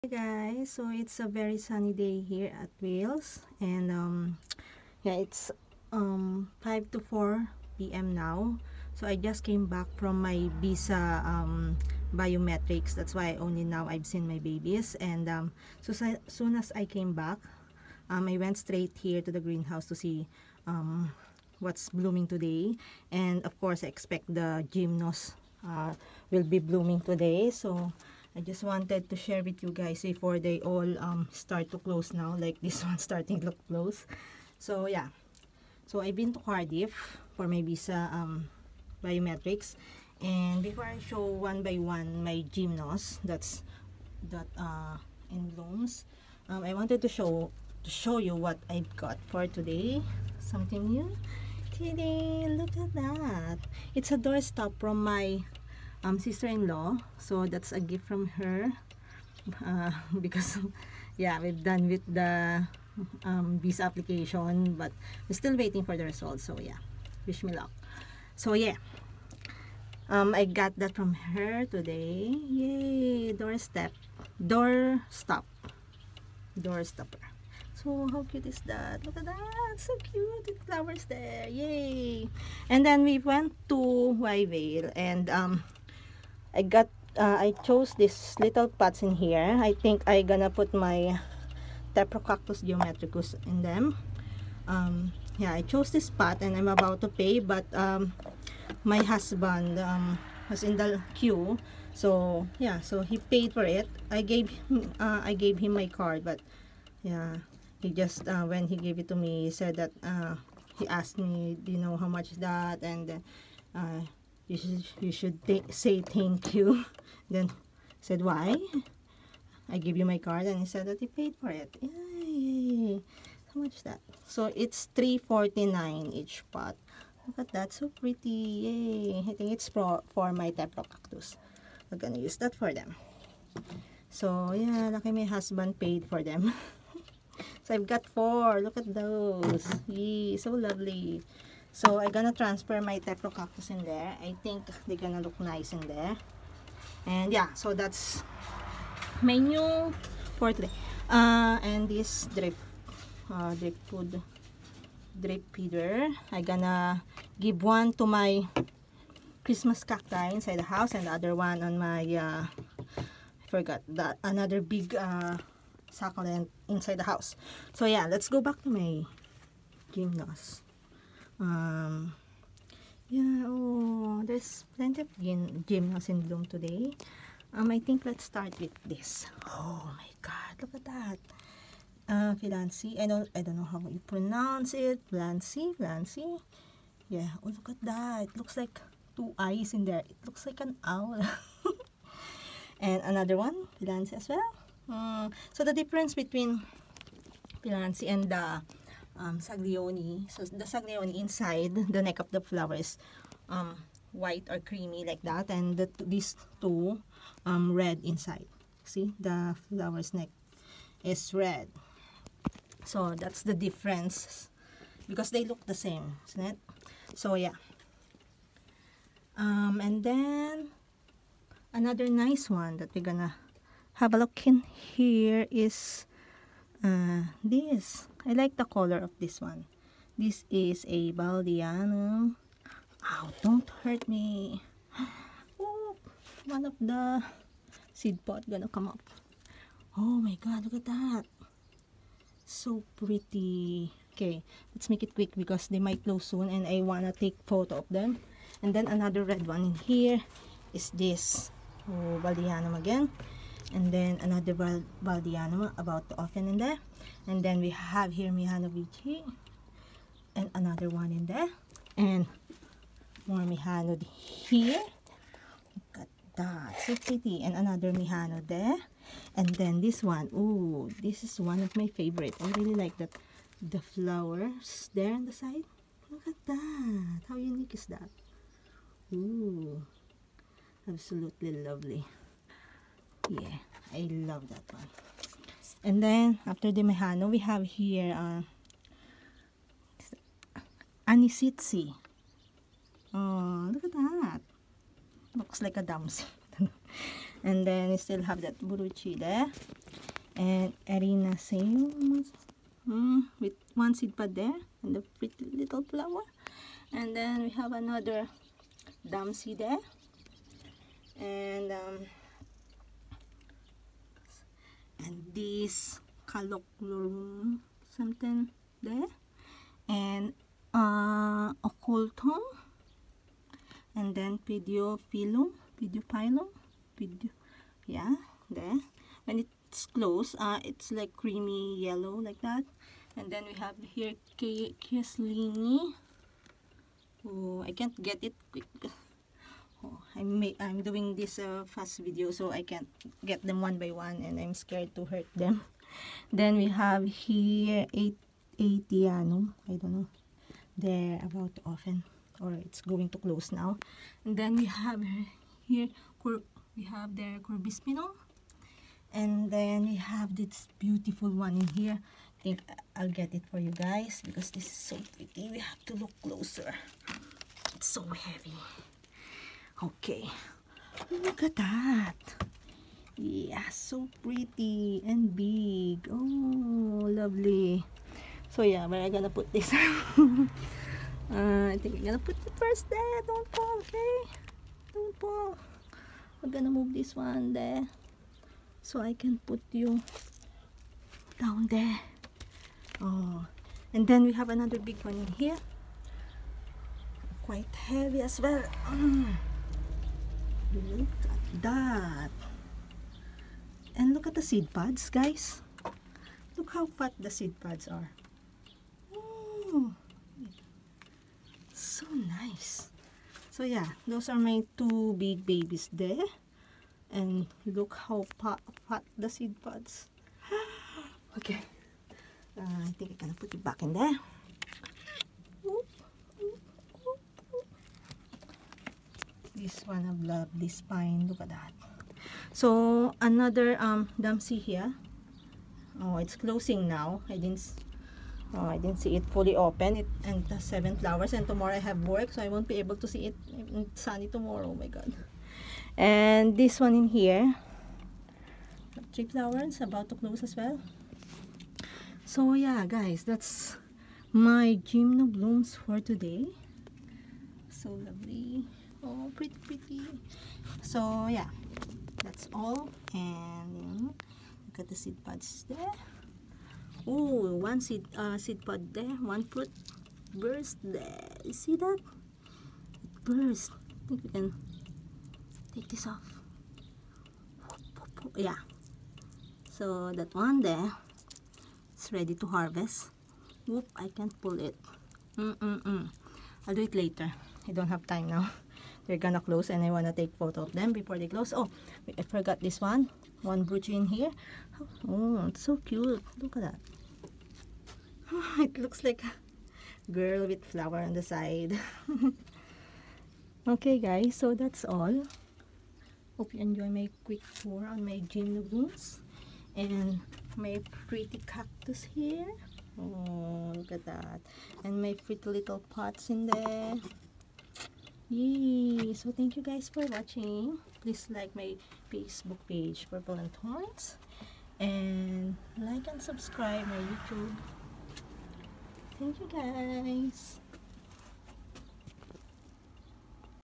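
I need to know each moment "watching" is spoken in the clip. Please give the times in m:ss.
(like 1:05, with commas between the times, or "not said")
8:40.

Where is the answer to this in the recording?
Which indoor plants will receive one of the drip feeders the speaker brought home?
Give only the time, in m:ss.
2:39.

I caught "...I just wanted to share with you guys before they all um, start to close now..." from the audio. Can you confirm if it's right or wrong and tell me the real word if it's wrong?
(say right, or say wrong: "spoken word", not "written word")
right.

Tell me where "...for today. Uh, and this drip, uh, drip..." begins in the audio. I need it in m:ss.
2:30.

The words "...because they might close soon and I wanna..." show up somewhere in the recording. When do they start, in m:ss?
4:05.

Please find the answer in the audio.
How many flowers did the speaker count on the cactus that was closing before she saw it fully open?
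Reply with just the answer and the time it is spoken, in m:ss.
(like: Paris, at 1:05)
7, at 7:20.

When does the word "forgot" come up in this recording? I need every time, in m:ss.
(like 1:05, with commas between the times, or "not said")
2:43, 8:12.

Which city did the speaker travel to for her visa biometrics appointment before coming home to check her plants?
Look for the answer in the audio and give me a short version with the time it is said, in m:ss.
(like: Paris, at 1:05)
Cardiff, at 0:36.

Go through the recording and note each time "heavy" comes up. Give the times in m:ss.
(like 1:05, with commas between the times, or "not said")
6:08, 6:37.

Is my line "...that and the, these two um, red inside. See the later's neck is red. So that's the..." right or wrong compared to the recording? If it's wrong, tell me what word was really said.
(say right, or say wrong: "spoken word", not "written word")
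wrong: "flower", not "later".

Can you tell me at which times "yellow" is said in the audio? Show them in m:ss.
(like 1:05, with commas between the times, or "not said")
5:31.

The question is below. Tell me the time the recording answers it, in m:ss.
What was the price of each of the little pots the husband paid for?
2:04.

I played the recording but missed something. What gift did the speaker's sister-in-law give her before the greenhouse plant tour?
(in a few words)
A doorstop.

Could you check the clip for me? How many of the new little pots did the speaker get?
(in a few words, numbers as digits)
4.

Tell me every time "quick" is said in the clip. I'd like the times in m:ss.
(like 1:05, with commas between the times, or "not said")
4:05, 5:38, 8:27.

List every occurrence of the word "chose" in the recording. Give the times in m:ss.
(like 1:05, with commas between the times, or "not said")
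1:27, 1:35.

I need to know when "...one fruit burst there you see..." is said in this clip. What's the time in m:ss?
7:49.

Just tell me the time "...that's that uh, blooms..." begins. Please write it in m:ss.
0:43.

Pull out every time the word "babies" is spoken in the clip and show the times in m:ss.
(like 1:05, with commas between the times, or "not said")
0:14, 6:55.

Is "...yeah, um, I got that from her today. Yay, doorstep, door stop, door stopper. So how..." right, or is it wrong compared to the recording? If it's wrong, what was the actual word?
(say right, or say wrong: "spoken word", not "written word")
right.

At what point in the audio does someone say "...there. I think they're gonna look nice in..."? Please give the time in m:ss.
2:23.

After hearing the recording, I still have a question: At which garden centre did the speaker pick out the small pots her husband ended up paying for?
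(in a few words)
Wyevale.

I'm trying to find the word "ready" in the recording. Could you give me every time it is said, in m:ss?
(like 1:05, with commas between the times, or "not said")
8:02.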